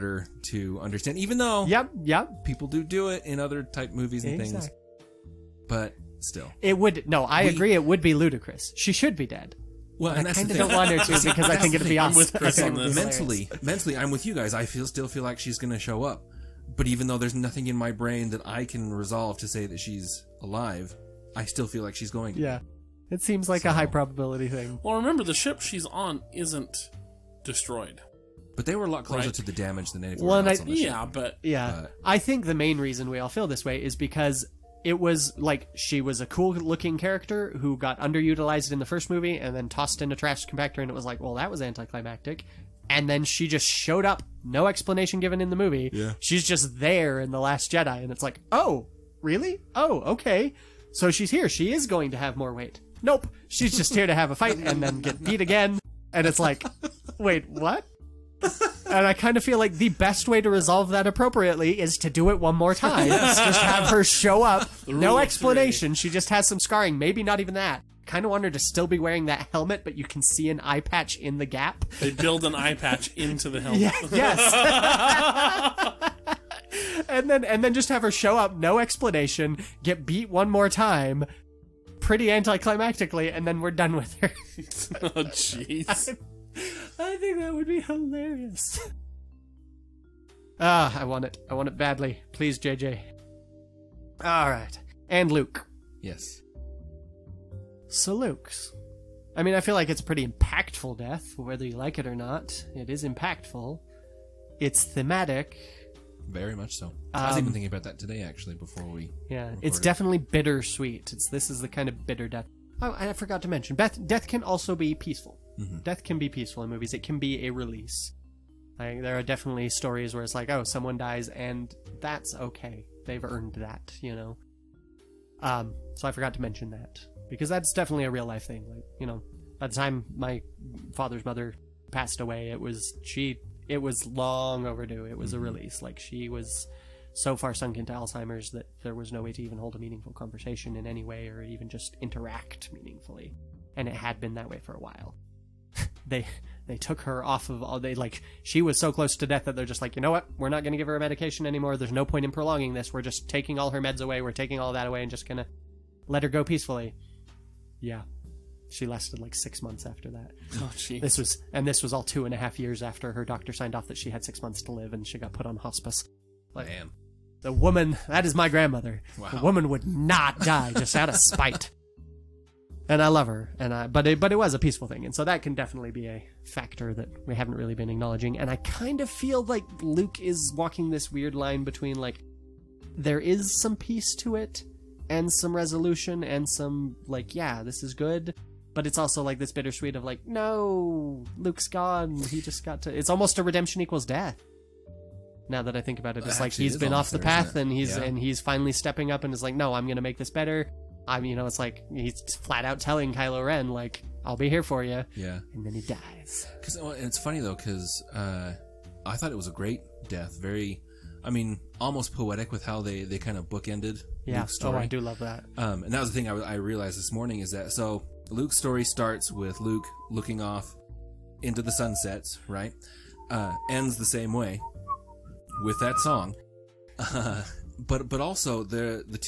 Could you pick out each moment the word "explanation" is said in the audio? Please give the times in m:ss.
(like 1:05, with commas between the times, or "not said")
0:44, 1:05, 1:18.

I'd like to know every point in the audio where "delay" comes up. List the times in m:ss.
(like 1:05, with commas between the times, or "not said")
not said.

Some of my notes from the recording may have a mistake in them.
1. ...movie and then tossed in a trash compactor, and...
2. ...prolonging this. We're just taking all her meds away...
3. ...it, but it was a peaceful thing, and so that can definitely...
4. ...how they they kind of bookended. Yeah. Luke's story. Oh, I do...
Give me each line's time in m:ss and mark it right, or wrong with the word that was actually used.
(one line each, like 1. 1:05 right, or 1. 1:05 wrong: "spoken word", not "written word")
1. 0:39 right
2. 2:32 right
3. 2:54 right
4. 3:32 right.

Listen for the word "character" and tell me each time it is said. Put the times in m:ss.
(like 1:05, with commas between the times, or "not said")
0:36.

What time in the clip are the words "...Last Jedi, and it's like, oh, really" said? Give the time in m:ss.
0:47.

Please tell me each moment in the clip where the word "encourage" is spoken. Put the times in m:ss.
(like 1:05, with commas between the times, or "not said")
not said.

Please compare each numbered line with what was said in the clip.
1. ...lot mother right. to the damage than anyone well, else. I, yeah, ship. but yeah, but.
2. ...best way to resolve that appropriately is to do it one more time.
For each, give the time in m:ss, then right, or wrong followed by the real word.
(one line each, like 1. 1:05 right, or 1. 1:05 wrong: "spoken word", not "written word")
1. 0:28 wrong: "closer", not "mother"
2. 0:59 right.